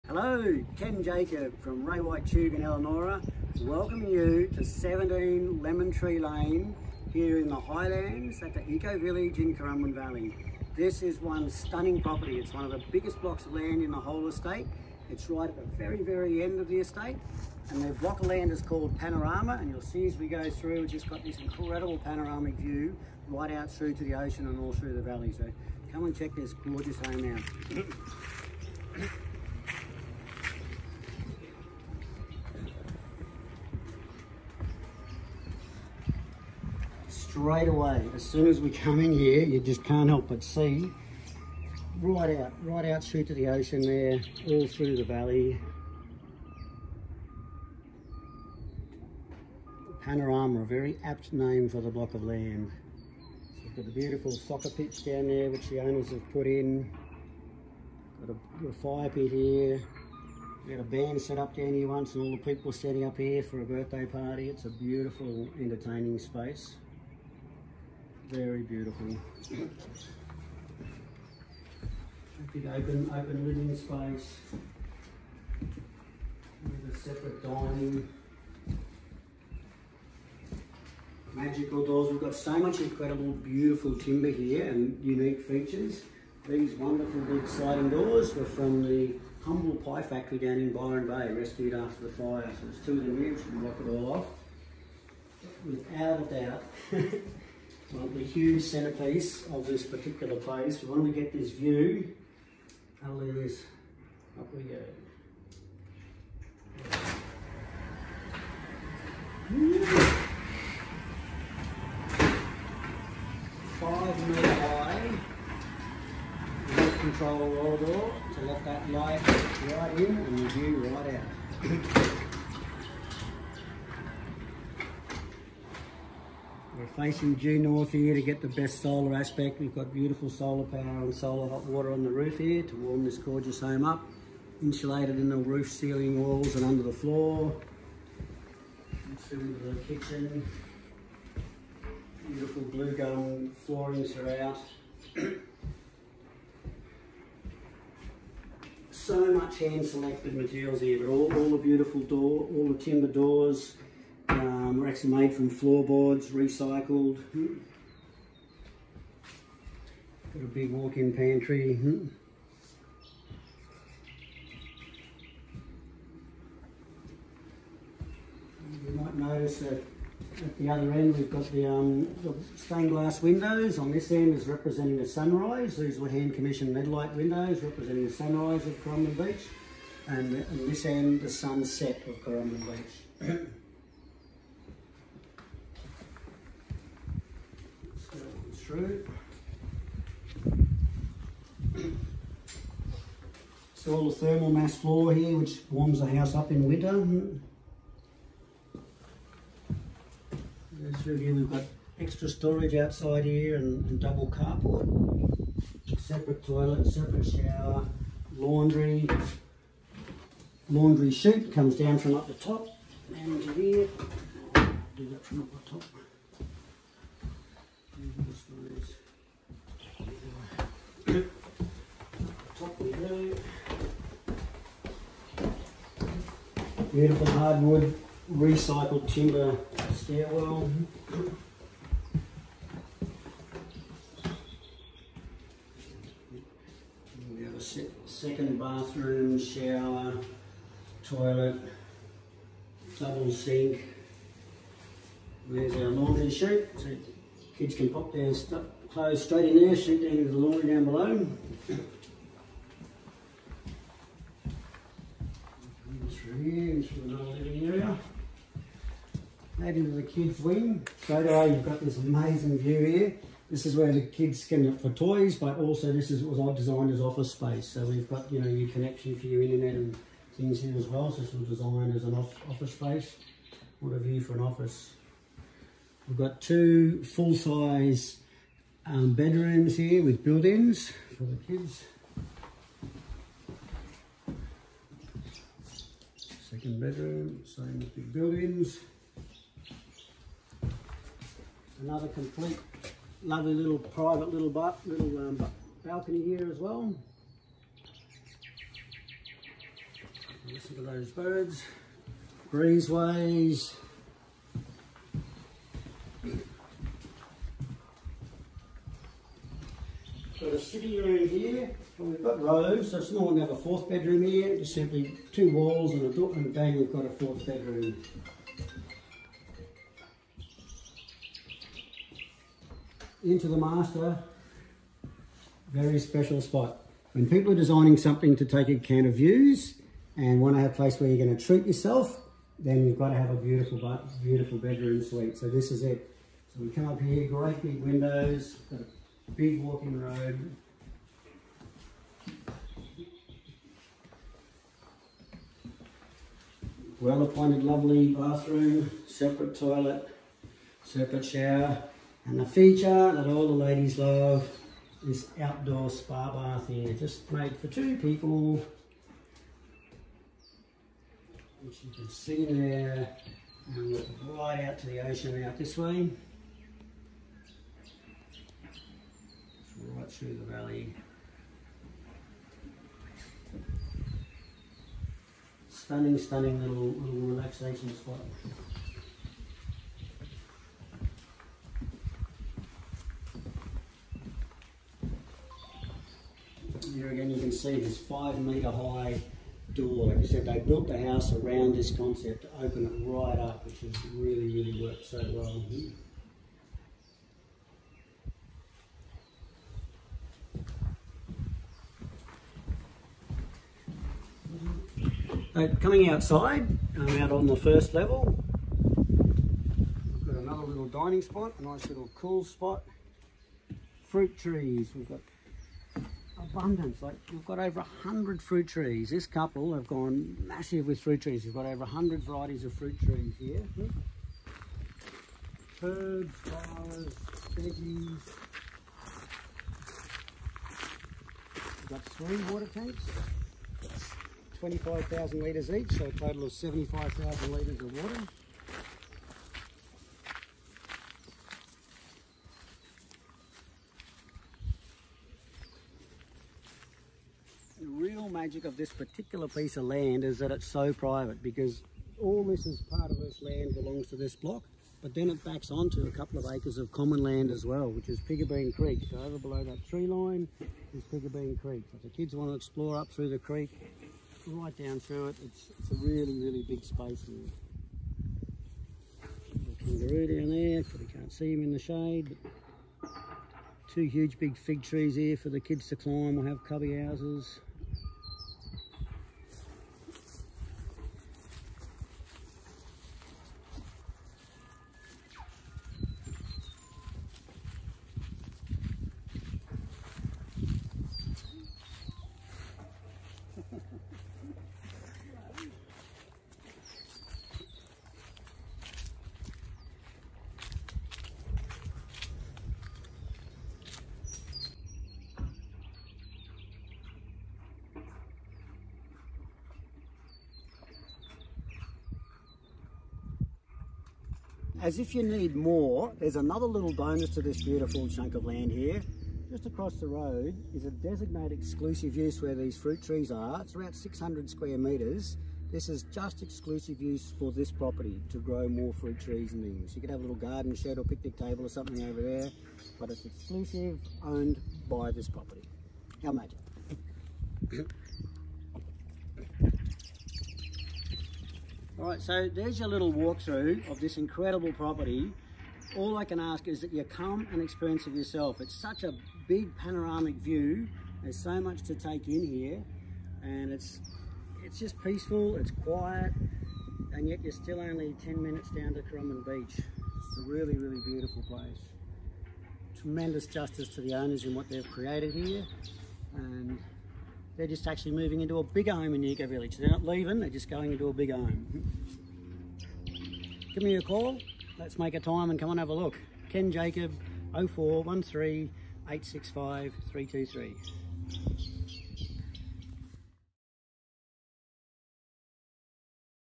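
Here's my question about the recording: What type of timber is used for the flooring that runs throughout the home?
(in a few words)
blue gum.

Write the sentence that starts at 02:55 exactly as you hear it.
These were hand commissioned lead light windows representing the sunrise of Coromandel Beach.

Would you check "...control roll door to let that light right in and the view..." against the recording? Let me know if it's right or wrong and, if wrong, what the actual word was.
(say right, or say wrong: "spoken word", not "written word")
right.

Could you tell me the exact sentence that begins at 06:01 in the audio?
Which you can see there, and look right out to the ocean out this way.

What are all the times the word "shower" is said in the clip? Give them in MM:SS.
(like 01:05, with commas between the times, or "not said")
03:27, 03:59, 05:51.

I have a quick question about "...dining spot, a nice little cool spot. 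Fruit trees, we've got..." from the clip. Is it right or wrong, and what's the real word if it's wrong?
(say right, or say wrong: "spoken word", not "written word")
right.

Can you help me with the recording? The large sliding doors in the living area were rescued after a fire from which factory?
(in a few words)
humble pie factory.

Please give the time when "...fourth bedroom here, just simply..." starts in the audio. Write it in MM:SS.
05:13.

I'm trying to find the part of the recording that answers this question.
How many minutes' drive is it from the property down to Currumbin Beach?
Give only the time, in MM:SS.
09:18.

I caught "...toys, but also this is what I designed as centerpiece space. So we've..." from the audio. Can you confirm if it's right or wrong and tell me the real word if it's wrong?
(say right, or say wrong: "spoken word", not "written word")
wrong: "office", not "centerpiece".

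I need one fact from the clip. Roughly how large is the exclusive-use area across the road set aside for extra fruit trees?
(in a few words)
600 square metres.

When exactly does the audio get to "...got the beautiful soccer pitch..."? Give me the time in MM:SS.
00:53.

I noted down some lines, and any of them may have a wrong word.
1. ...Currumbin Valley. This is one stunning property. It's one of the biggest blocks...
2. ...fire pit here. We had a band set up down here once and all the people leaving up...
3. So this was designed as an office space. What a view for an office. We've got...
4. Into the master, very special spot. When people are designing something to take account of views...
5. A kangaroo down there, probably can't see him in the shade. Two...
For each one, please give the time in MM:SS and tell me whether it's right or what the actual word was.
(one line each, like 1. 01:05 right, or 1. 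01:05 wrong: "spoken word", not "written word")
1. 00:09 right
2. 00:58 wrong: "setting", not "leaving"
3. 04:31 right
4. 05:23 right
5. 07:49 right.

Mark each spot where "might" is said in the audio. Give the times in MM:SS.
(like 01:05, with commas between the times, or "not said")
02:48.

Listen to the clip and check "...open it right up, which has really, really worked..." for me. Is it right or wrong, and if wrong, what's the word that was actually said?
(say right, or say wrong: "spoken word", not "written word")
right.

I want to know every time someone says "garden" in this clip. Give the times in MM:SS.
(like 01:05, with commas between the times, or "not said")
08:50.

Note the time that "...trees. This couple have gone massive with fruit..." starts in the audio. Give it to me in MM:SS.
06:58.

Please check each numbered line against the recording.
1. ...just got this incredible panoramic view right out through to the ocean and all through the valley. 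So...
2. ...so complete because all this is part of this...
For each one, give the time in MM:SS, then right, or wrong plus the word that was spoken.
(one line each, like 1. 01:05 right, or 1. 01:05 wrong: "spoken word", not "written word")
1. 00:20 right
2. 07:30 wrong: "private", not "complete".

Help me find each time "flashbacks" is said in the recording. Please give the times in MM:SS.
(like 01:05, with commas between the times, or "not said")
not said.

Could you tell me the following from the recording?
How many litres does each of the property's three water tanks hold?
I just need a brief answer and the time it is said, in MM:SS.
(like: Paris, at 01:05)
25,000 litres, at 07:14.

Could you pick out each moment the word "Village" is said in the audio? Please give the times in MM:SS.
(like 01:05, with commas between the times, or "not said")
00:08, 09:29.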